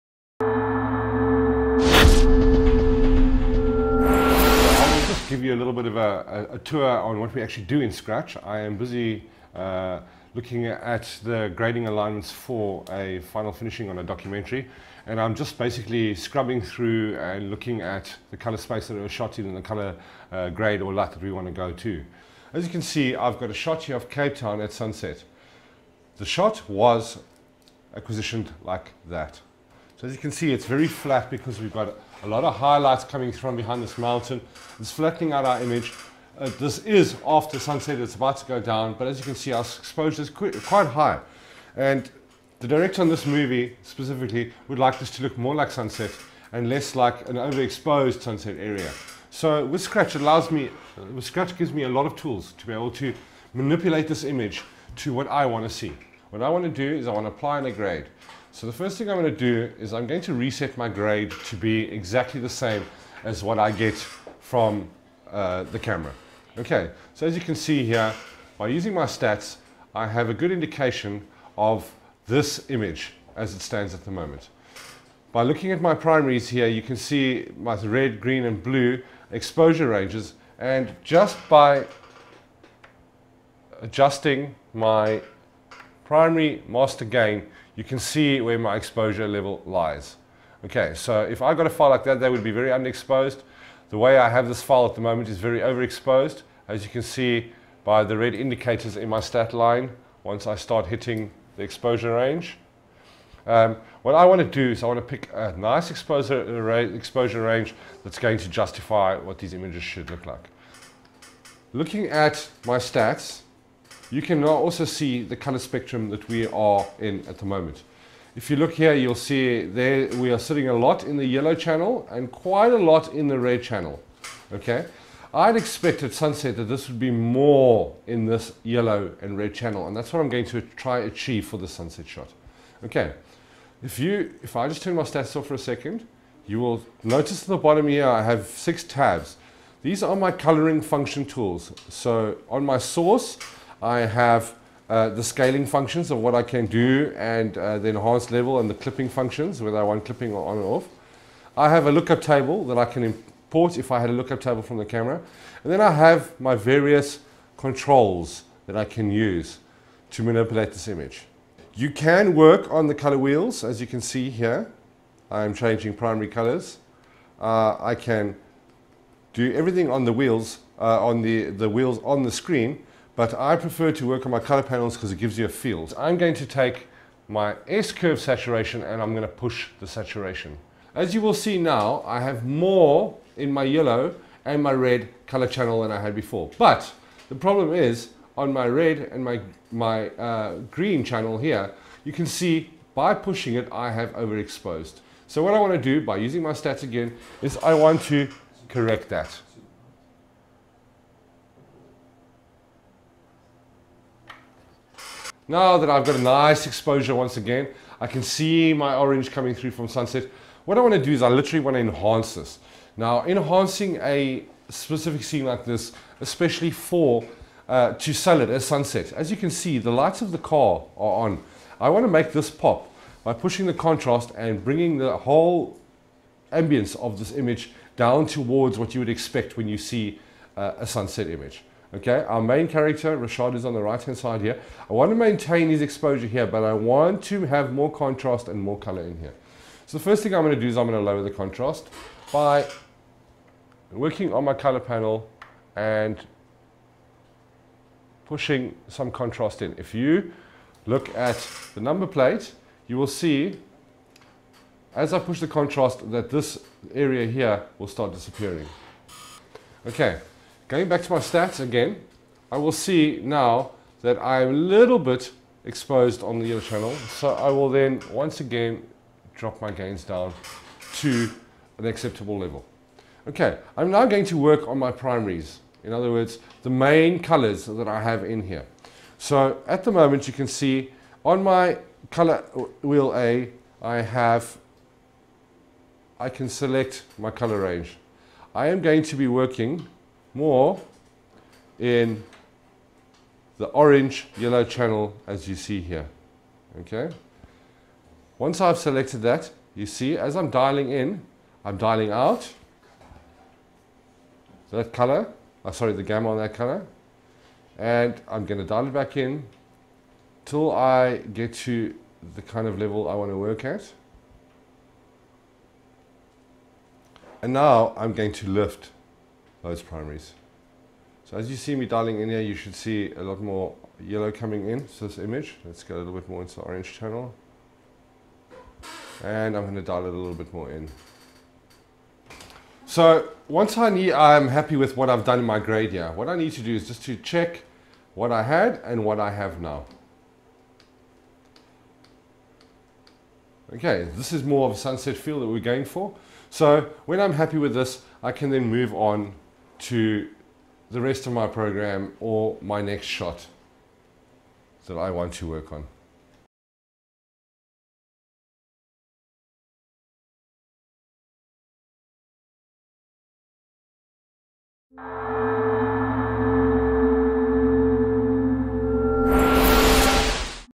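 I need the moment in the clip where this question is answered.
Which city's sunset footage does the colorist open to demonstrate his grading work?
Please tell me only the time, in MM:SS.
00:24.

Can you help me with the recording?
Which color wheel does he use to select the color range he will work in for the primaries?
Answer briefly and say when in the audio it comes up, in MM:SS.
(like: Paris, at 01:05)
Wheel A, at 04:42.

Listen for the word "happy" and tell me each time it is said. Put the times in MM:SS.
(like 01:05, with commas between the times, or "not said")
05:34, 05:47.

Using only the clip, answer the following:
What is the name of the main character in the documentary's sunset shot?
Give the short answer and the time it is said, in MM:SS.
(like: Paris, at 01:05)
Rashad, at 03:53.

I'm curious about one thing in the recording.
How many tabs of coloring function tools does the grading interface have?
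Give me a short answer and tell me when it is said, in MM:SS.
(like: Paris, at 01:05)
6, at 02:18.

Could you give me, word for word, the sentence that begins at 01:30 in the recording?
Okay, so if I got a file like that, that would be very underexposed.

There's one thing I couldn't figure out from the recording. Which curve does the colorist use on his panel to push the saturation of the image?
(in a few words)
S-curve.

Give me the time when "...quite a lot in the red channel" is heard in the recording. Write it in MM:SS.
02:02.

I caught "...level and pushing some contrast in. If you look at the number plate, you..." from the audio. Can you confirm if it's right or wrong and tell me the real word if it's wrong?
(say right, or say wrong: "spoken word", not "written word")
wrong: "panel", not "level".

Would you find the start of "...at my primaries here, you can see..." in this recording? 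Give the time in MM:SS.
01:15.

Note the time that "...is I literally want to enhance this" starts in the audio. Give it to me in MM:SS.
03:31.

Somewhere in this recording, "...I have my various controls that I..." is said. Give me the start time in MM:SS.
02:35.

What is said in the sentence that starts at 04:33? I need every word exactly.
Okay, I'm now going to work on my primaries.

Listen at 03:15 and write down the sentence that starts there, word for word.
So what I want to do by using my stats again is I want to correct that.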